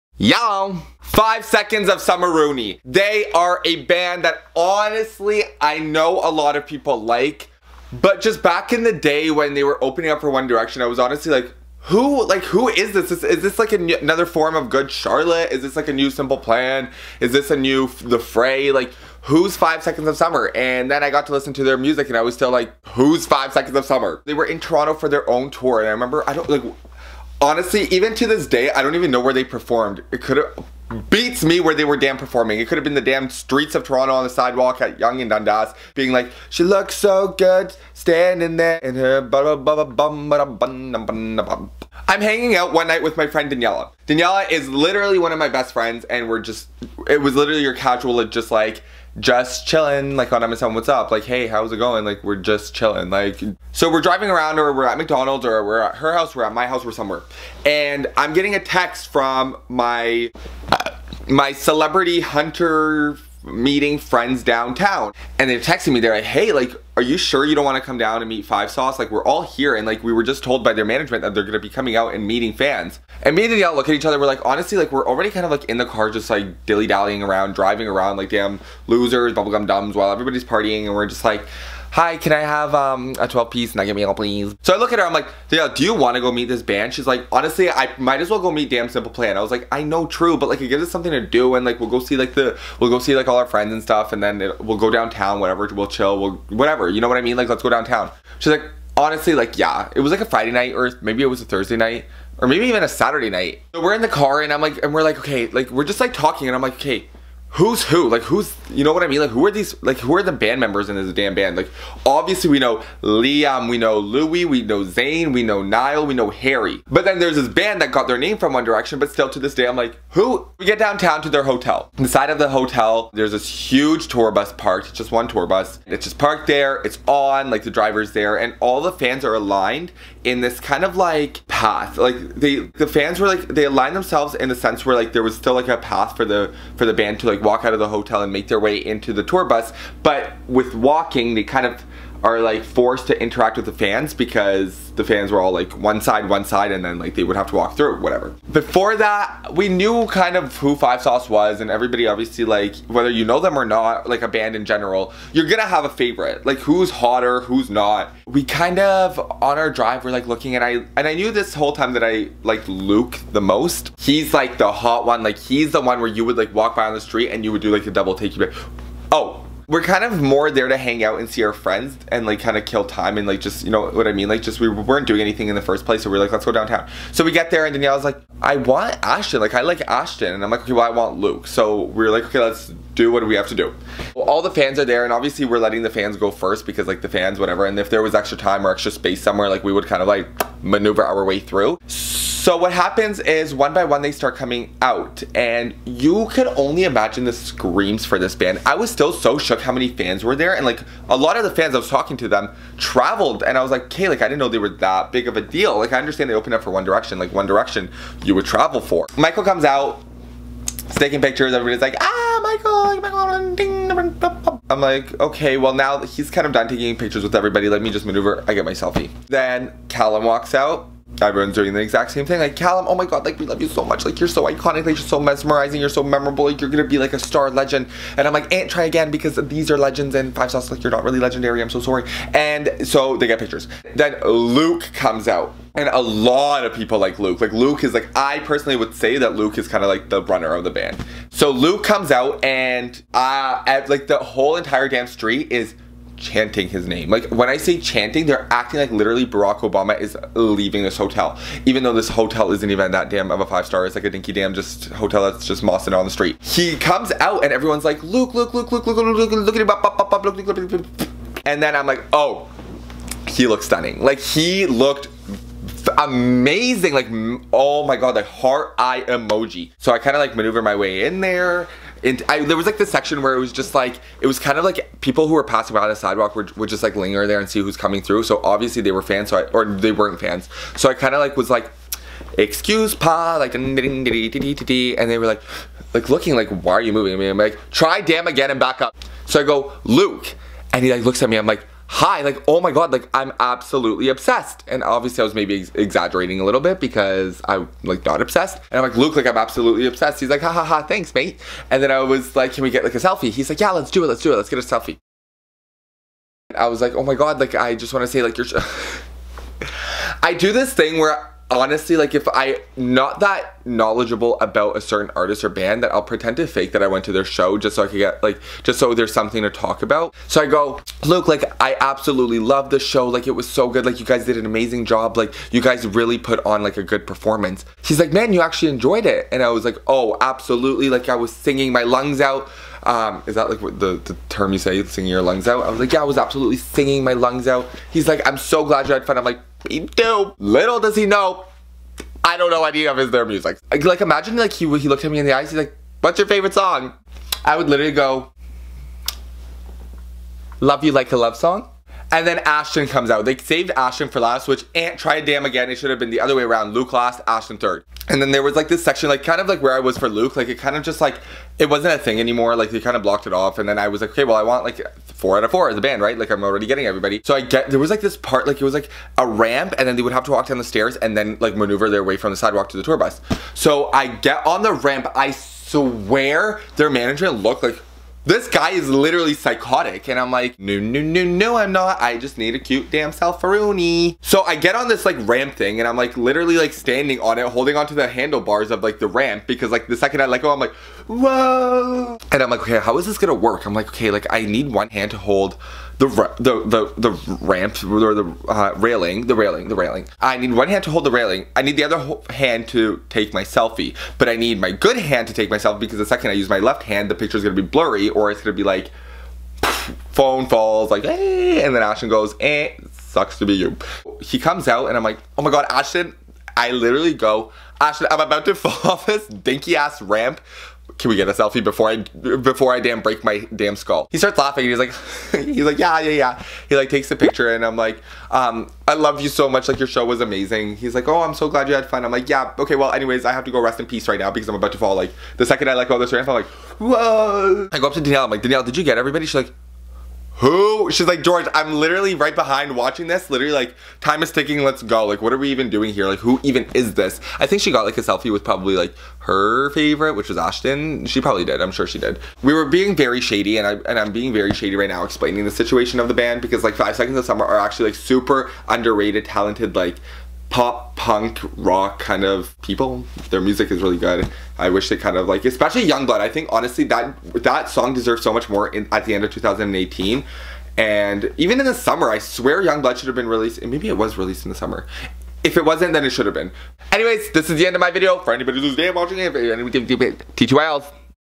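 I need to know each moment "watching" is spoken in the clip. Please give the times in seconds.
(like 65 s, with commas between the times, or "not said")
442 s, 478 s.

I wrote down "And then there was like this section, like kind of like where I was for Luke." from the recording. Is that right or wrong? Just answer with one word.
right.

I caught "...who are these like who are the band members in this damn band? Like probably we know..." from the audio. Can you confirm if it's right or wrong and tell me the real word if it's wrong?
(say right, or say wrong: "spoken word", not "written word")
wrong: "obviously", not "probably".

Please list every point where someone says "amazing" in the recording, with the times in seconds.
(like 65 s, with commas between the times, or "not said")
265 s, 324 s, 430 s.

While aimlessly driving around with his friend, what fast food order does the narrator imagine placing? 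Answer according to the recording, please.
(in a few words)
12 piece nugget meal.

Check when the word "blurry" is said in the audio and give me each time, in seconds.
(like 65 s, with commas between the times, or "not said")
407 s.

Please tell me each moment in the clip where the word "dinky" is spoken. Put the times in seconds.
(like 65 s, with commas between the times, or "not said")
254 s, 419 s.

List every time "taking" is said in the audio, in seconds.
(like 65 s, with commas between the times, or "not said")
210 s, 216 s.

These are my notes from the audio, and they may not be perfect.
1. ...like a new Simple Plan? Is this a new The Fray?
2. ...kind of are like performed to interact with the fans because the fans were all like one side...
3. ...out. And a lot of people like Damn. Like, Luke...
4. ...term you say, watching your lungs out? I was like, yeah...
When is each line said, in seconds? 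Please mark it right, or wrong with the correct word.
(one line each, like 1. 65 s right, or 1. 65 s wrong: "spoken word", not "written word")
1. 15 s right
2. 141 s wrong: "forced", not "performed"
3. 235 s wrong: "Luke", not "Damn"
4. 334 s wrong: "singing", not "watching".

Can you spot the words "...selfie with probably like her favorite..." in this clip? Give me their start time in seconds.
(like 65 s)
448 s.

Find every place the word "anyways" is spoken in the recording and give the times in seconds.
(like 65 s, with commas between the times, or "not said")
432 s, 476 s.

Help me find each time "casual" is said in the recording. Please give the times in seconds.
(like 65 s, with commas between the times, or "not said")
47 s.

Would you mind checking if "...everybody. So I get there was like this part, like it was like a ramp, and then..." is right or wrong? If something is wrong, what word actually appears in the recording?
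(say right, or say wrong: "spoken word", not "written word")
right.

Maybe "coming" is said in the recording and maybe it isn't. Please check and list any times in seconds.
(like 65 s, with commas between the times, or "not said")
71 s, 194 s, 277 s.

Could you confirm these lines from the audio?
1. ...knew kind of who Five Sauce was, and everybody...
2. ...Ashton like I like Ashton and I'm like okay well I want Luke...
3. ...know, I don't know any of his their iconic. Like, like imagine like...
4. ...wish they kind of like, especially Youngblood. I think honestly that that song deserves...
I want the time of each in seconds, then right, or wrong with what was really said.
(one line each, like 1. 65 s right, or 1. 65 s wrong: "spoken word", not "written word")
1. 149 s right
2. 179 s right
3. 341 s wrong: "music", not "iconic"
4. 464 s right.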